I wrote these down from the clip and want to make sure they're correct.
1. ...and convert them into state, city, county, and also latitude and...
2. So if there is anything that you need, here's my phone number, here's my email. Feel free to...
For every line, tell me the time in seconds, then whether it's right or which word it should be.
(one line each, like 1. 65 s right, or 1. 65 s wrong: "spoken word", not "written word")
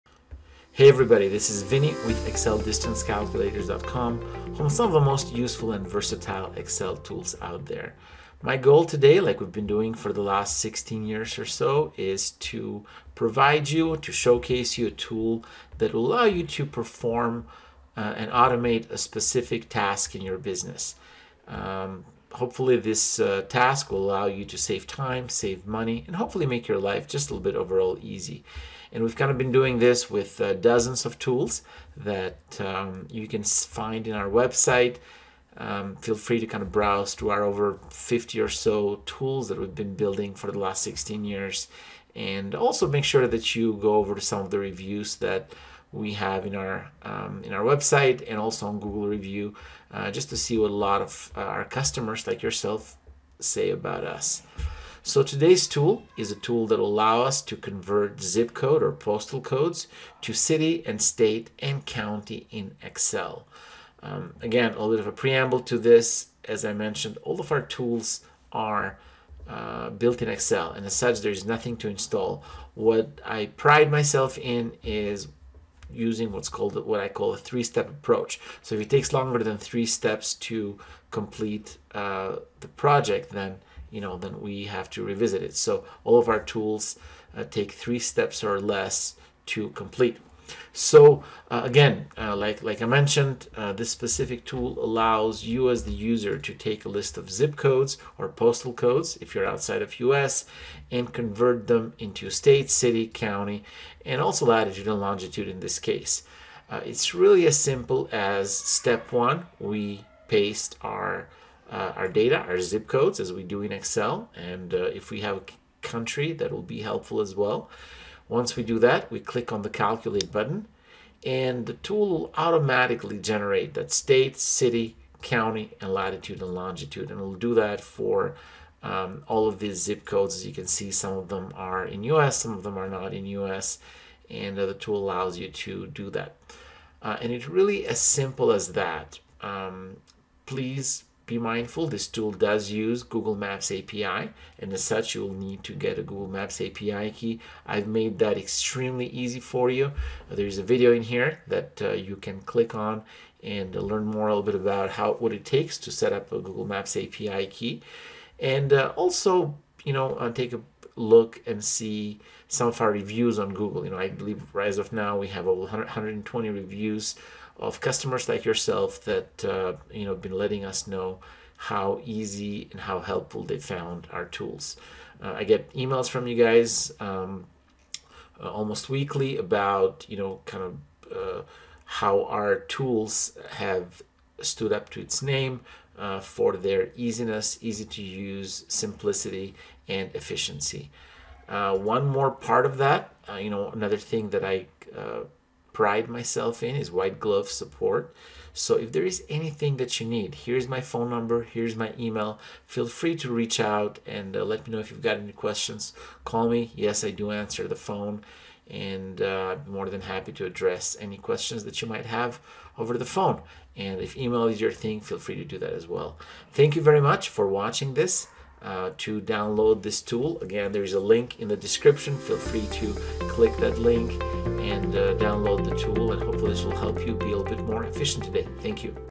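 1. 100 s right
2. 198 s right.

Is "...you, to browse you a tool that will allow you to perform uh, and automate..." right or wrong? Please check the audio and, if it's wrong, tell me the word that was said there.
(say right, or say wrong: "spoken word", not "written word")
wrong: "showcase", not "browse".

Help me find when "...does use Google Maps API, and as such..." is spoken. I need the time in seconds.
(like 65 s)
142 s.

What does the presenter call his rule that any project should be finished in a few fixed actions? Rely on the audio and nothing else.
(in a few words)
three-step approach.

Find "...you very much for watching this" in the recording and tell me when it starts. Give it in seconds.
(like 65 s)
216 s.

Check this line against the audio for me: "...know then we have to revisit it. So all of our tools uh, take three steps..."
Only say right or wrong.
right.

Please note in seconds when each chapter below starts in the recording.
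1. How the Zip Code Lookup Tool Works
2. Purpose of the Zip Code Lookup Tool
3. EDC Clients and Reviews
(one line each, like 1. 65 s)
1. 107 s
2. 54 s
3. 162 s.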